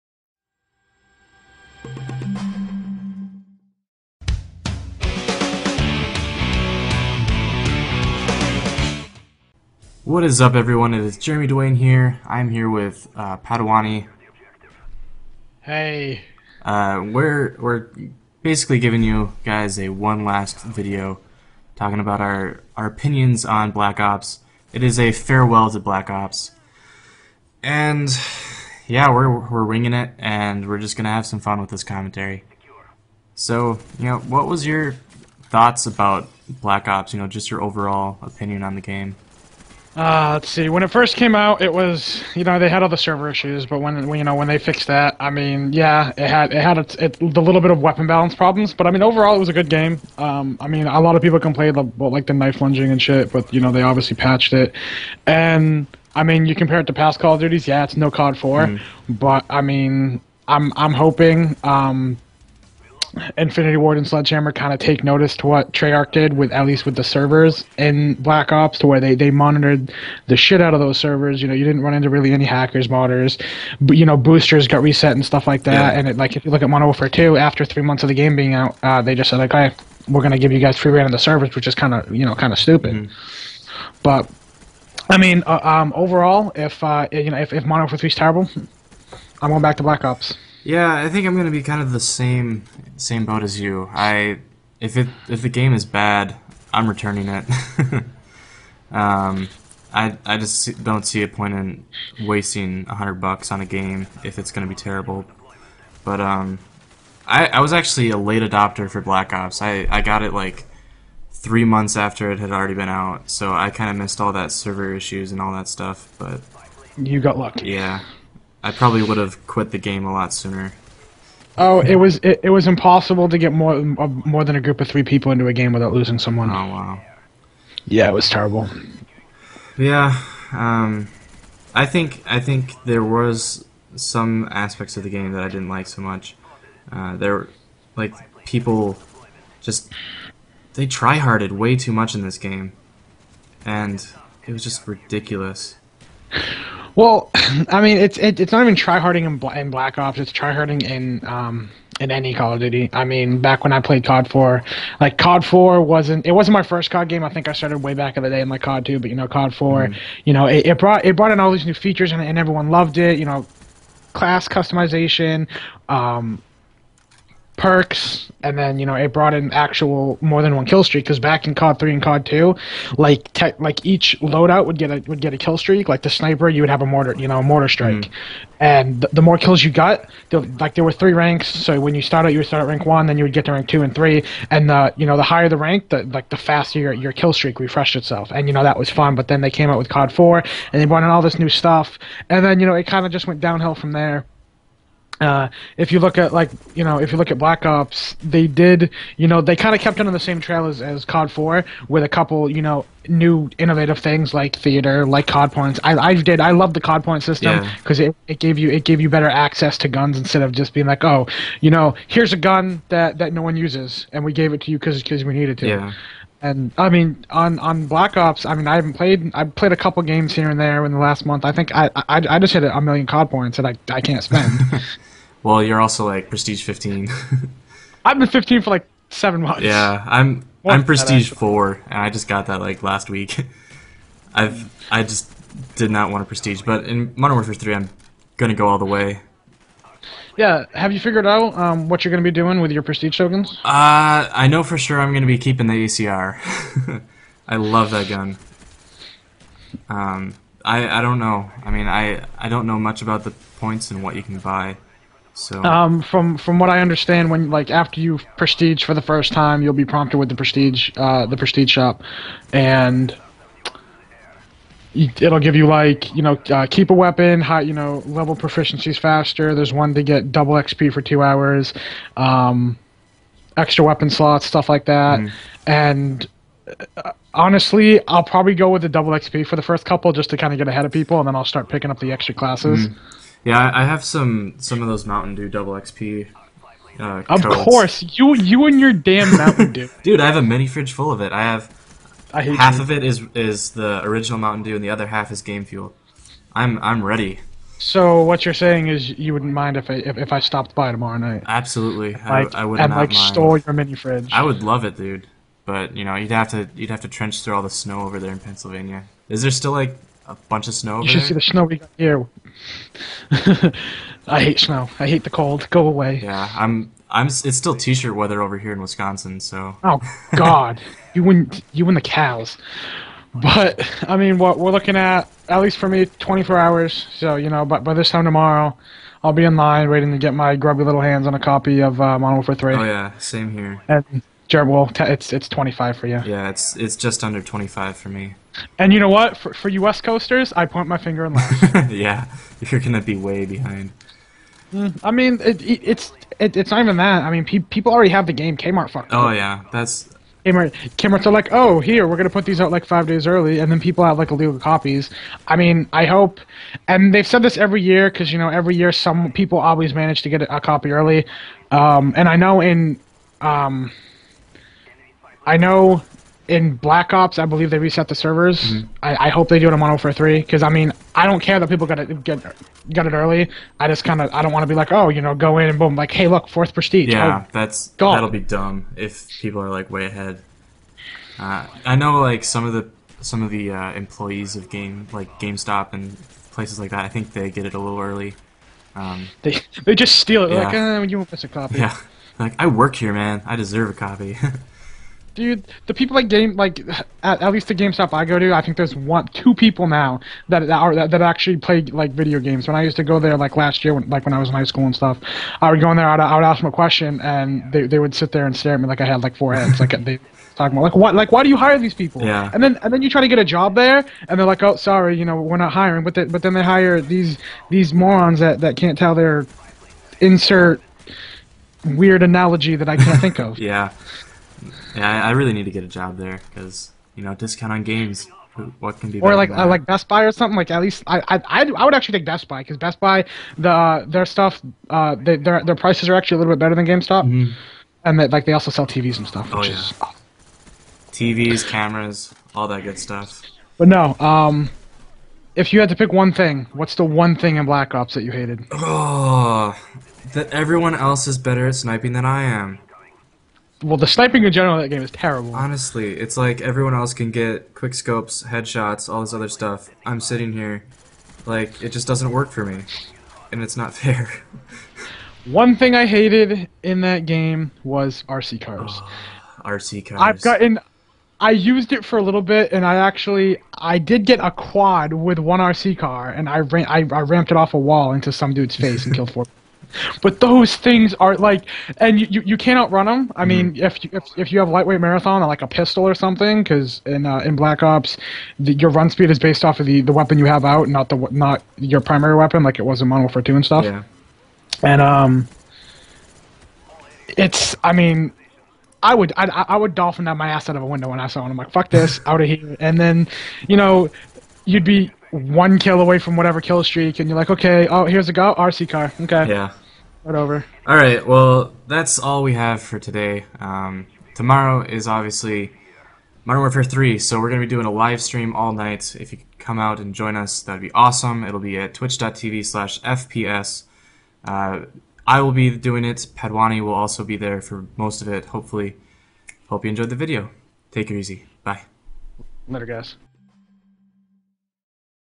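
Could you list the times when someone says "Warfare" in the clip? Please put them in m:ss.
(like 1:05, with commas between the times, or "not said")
1:16, 1:27, 3:57, 8:13, 8:36.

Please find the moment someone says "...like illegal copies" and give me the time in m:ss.
5:54.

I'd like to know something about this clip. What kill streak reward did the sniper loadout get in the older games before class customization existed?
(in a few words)
a mortar strike.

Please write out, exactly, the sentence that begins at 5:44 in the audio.
Mm, I mean, it, it, it's it, it's not even that.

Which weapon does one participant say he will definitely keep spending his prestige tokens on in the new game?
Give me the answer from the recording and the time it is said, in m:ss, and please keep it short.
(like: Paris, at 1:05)
the ACR, at 4:05.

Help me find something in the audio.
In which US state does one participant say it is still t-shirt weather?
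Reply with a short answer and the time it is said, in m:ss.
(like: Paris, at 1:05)
Wisconsin, at 5:18.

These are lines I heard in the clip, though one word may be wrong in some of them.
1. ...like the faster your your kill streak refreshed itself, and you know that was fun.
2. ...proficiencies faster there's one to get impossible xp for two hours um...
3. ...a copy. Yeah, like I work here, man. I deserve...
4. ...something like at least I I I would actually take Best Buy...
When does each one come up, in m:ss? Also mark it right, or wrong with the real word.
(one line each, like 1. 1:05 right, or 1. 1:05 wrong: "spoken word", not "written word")
1. 3:06 right
2. 4:28 wrong: "double", not "impossible"
3. 6:31 right
4. 7:10 right.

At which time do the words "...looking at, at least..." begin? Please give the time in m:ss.
5:24.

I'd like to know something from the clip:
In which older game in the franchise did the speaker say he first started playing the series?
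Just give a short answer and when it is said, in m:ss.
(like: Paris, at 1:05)
COD 2, at 2:38.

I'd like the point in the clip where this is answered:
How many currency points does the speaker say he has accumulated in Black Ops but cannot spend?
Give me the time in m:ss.
3:42.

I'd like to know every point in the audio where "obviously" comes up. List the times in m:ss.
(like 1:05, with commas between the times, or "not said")
0:53, 8:35.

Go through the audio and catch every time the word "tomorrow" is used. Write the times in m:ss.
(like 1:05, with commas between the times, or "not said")
5:00, 5:28, 8:34.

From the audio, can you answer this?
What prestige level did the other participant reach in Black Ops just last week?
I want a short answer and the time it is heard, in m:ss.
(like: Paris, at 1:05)
Prestige 4, at 3:50.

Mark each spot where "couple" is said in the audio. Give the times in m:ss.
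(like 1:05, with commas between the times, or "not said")
3:22, 3:39, 4:39.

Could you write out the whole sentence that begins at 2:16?
Uh, there, like people just they tryharded way too much in this game.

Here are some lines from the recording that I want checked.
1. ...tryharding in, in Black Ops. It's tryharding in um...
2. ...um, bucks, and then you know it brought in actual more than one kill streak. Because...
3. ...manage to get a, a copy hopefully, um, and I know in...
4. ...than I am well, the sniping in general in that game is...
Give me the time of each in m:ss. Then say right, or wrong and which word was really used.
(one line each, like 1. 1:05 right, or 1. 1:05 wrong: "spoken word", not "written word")
1. 2:28 right
2. 2:45 wrong: "perks", not "bucks"
3. 5:59 wrong: "early", not "hopefully"
4. 7:32 right.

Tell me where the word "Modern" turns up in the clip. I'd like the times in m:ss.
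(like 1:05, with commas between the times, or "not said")
1:16, 1:27, 3:57, 8:13, 8:36.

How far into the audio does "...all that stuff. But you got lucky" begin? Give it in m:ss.
1:55.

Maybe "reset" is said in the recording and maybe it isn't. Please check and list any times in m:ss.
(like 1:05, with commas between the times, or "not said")
1:14, 6:07.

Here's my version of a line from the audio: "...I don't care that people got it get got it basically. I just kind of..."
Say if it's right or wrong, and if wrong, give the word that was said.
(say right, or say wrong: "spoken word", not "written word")
wrong: "early", not "basically".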